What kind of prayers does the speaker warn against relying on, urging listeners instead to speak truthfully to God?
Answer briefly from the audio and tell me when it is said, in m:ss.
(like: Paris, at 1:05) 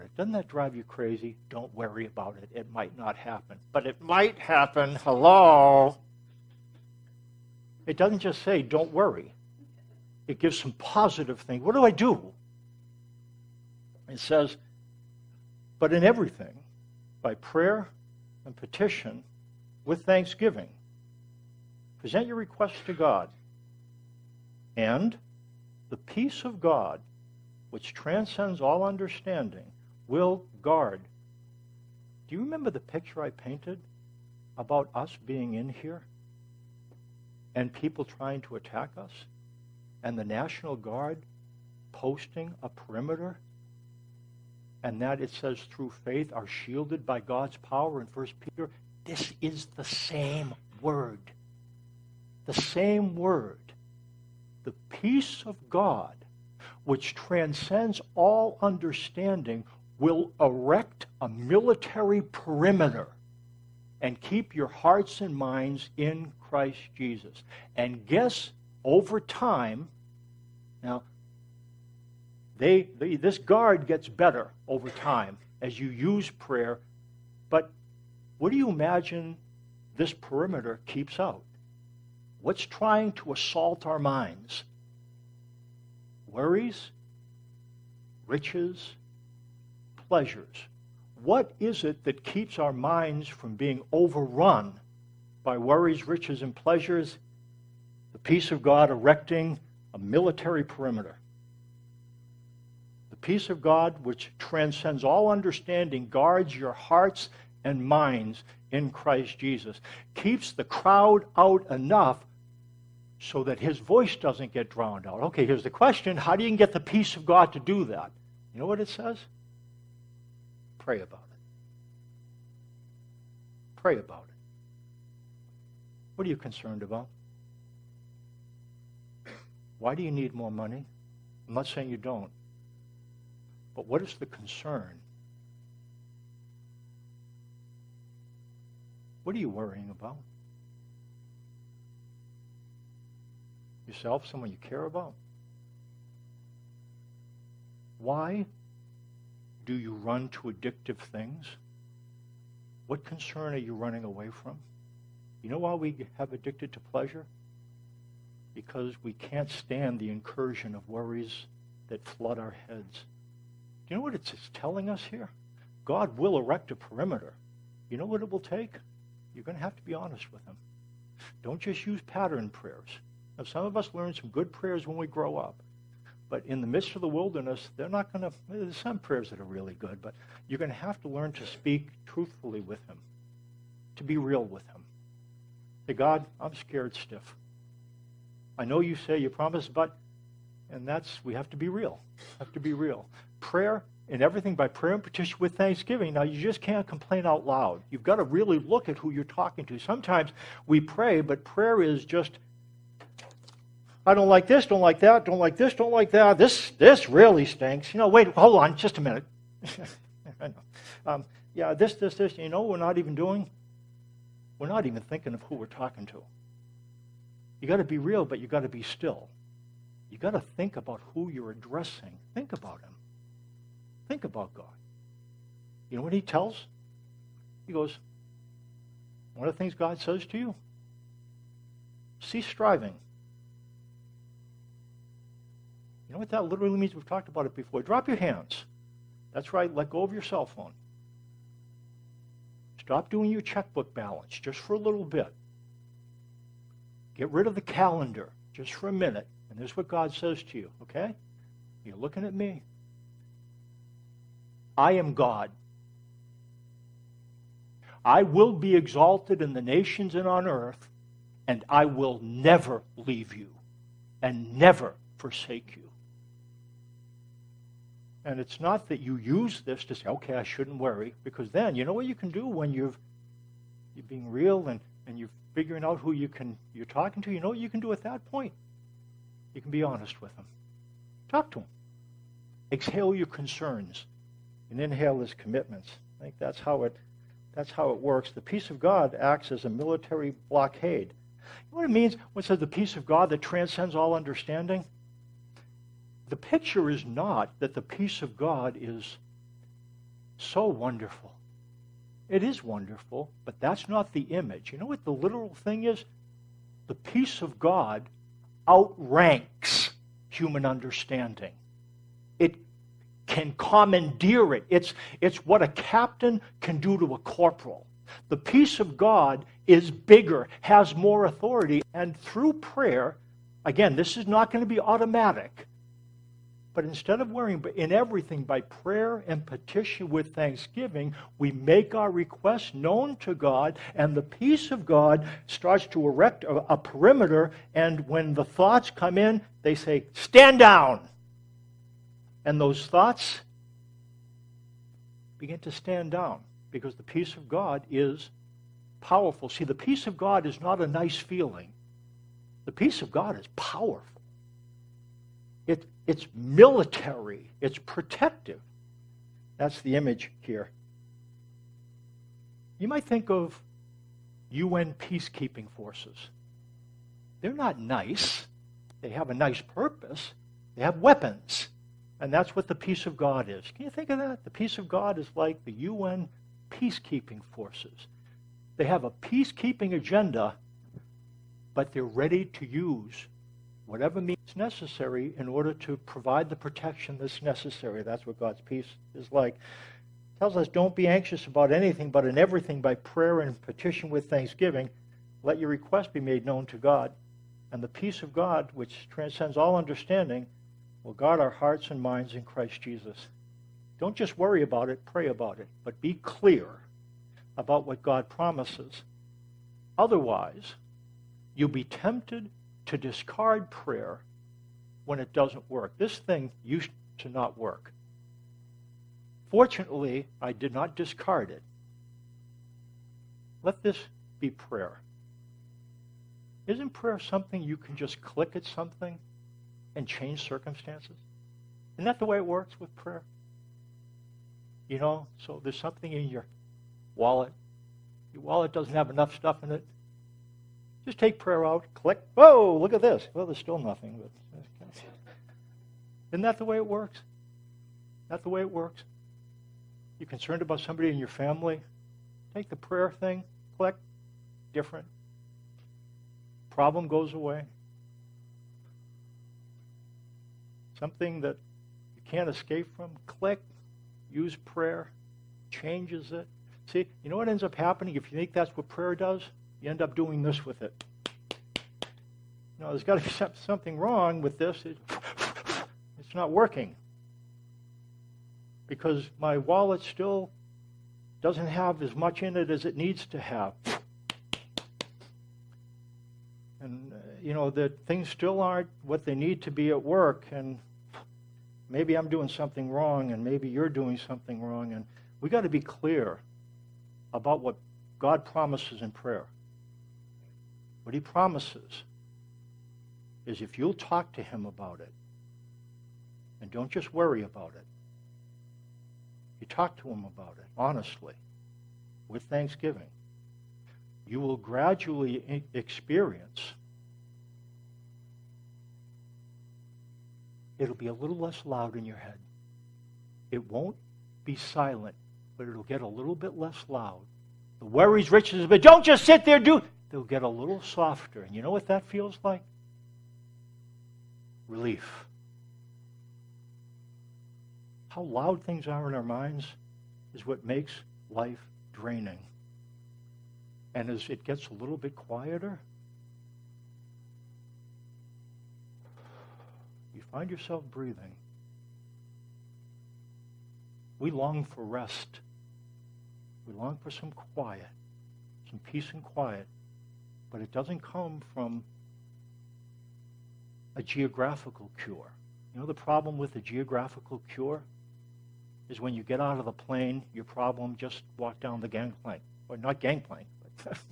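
pattern prayers, at 2:52.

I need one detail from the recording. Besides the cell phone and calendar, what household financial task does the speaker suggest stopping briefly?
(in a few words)
checkbook balance.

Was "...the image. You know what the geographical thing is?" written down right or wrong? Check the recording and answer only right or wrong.
wrong.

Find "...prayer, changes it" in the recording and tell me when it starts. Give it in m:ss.
7:44.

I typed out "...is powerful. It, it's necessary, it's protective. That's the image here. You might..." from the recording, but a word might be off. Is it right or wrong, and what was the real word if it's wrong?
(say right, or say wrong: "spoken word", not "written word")
wrong: "military", not "necessary".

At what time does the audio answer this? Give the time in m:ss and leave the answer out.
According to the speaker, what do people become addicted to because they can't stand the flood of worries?
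2:36.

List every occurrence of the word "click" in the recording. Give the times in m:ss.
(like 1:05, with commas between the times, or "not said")
7:08, 7:21, 7:33, 7:43.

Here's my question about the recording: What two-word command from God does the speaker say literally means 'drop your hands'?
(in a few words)
cease striving.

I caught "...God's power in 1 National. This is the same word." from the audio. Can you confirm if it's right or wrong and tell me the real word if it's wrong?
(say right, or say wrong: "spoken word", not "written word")
wrong: "Peter", not "National".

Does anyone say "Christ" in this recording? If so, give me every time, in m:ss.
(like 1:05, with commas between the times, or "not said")
1:06, 1:48, 6:42.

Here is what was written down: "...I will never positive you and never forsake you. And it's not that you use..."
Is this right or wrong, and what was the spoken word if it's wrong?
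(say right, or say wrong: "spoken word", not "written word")
wrong: "leave", not "positive".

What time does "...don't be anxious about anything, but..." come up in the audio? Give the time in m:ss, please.
6:30.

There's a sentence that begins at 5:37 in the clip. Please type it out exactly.
And when the thoughts come in, they say, Stand down!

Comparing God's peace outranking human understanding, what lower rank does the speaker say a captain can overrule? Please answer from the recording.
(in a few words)
corporal.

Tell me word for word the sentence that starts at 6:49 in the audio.
Otherwise, you'll be tempted to discard prayer when it doesn't work.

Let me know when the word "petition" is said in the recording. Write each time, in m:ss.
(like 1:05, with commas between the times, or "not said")
0:18, 3:15, 5:29, 6:33.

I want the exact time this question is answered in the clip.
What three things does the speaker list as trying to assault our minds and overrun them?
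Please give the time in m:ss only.
1:26.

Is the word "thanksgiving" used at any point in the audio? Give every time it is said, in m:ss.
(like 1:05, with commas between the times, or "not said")
0:20, 3:15, 5:30, 6:34, 8:32.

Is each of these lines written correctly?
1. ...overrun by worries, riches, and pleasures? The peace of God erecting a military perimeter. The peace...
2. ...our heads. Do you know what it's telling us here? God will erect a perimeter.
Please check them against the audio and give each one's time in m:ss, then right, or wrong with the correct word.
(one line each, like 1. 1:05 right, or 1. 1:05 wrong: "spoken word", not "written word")
1. 1:33 right
2. 2:42 right.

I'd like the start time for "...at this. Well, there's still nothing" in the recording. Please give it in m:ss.
7:22.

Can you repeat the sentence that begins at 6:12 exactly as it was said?
And that's what the peace of God is.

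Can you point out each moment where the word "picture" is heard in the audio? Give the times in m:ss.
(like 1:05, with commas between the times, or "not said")
0:32, 4:56.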